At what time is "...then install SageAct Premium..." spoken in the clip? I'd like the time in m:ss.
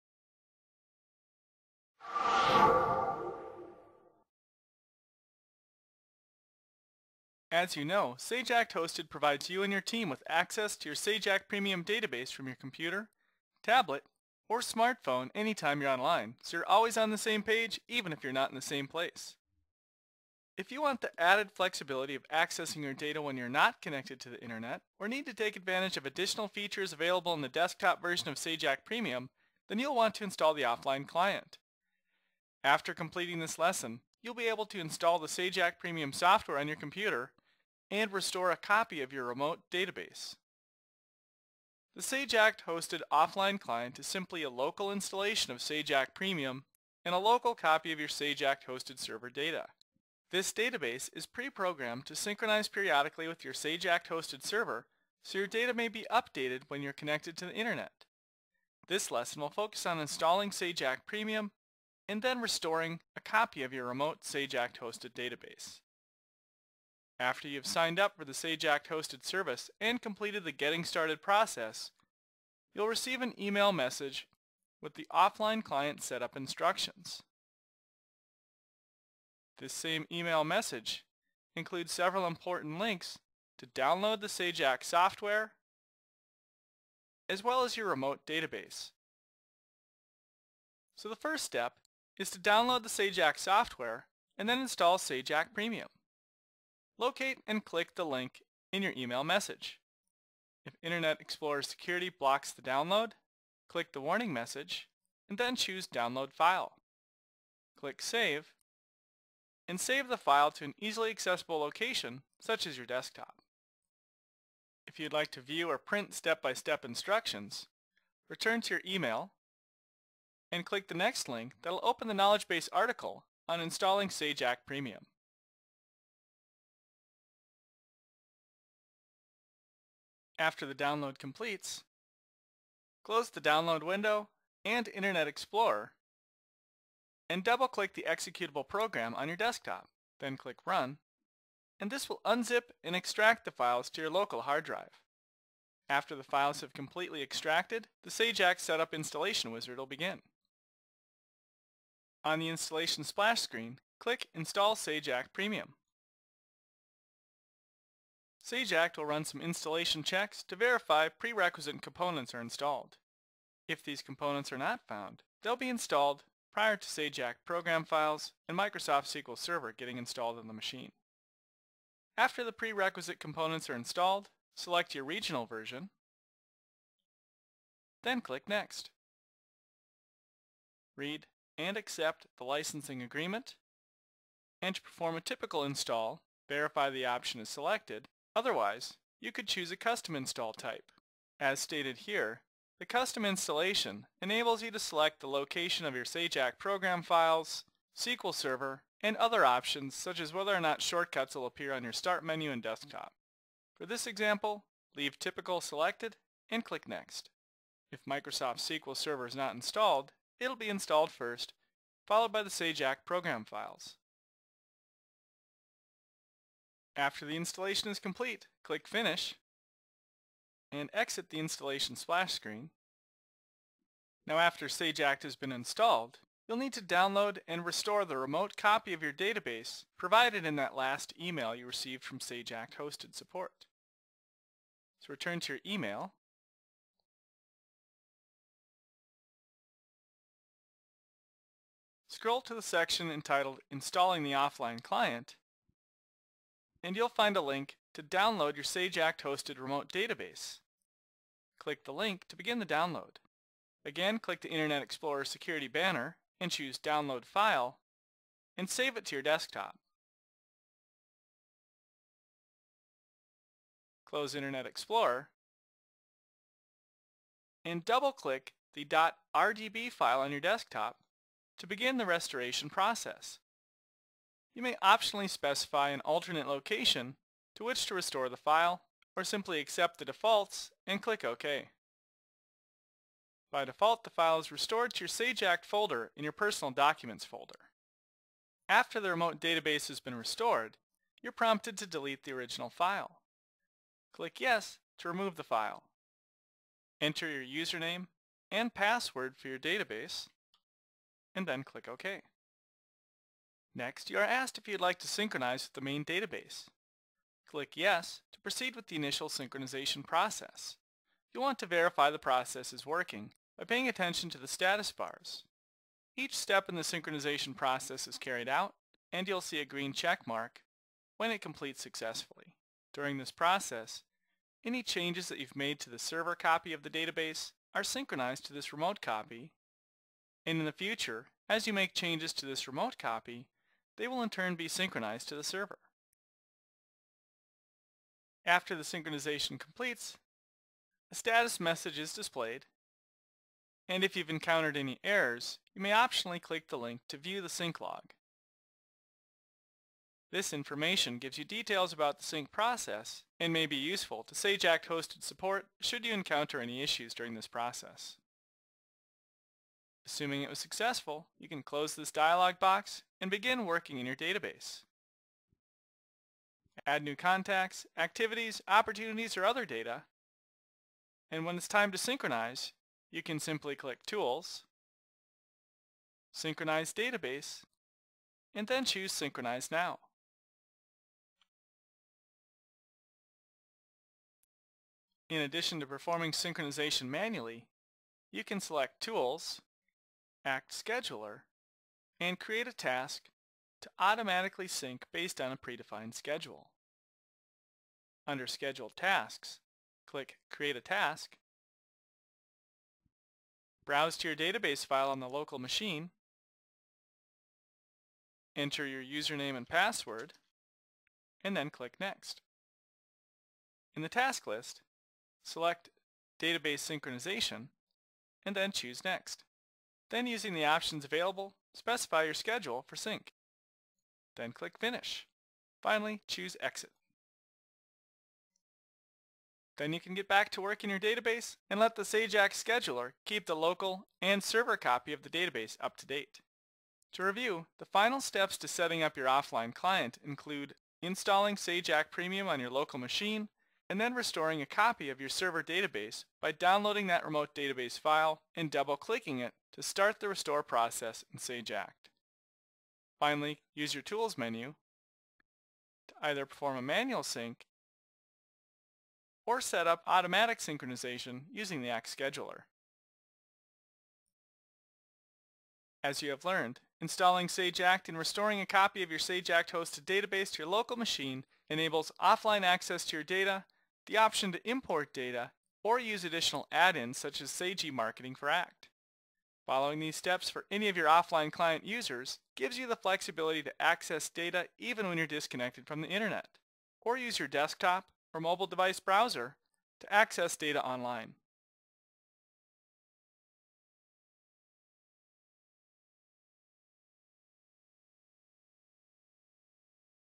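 1:34.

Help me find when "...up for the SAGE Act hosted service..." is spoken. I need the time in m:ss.
1:07.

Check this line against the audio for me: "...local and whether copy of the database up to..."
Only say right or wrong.
wrong.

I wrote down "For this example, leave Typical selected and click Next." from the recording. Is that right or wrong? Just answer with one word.
right.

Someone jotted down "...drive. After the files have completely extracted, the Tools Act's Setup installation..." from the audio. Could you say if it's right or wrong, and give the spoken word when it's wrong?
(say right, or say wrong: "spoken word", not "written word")
wrong: "Sage", not "Tools".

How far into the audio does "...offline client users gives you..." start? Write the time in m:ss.
8:01.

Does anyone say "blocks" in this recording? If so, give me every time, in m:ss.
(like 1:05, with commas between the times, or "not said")
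1:42.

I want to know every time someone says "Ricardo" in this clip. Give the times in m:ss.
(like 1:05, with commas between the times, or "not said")
not said.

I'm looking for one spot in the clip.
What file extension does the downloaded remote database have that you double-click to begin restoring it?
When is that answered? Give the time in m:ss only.
4:29.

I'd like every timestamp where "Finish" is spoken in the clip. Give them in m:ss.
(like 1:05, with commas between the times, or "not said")
3:38, 7:04.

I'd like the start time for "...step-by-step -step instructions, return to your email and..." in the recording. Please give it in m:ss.
1:56.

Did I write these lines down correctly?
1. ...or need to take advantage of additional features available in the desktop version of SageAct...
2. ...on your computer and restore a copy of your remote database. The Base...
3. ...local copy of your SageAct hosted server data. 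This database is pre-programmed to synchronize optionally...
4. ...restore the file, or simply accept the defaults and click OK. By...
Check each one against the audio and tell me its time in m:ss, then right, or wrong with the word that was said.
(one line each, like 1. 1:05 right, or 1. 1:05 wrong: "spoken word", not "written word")
1. 0:24 right
2. 0:36 wrong: "SageAct", not "Base"
3. 0:47 wrong: "periodically", not "optionally"
4. 4:37 right.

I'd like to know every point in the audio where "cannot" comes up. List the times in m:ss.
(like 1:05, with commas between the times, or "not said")
not said.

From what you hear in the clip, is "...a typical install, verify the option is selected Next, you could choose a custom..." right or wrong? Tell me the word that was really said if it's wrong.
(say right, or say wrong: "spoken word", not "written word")
wrong: "Otherwise", not "Next".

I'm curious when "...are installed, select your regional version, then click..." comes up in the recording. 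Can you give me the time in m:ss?
2:53.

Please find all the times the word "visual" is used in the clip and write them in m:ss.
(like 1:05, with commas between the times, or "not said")
not said.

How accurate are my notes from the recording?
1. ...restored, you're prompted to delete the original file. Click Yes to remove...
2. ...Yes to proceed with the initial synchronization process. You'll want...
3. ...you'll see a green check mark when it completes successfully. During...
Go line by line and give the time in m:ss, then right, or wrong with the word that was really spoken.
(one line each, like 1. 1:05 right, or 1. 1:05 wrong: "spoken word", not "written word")
1. 4:50 right
2. 5:07 right
3. 5:19 right.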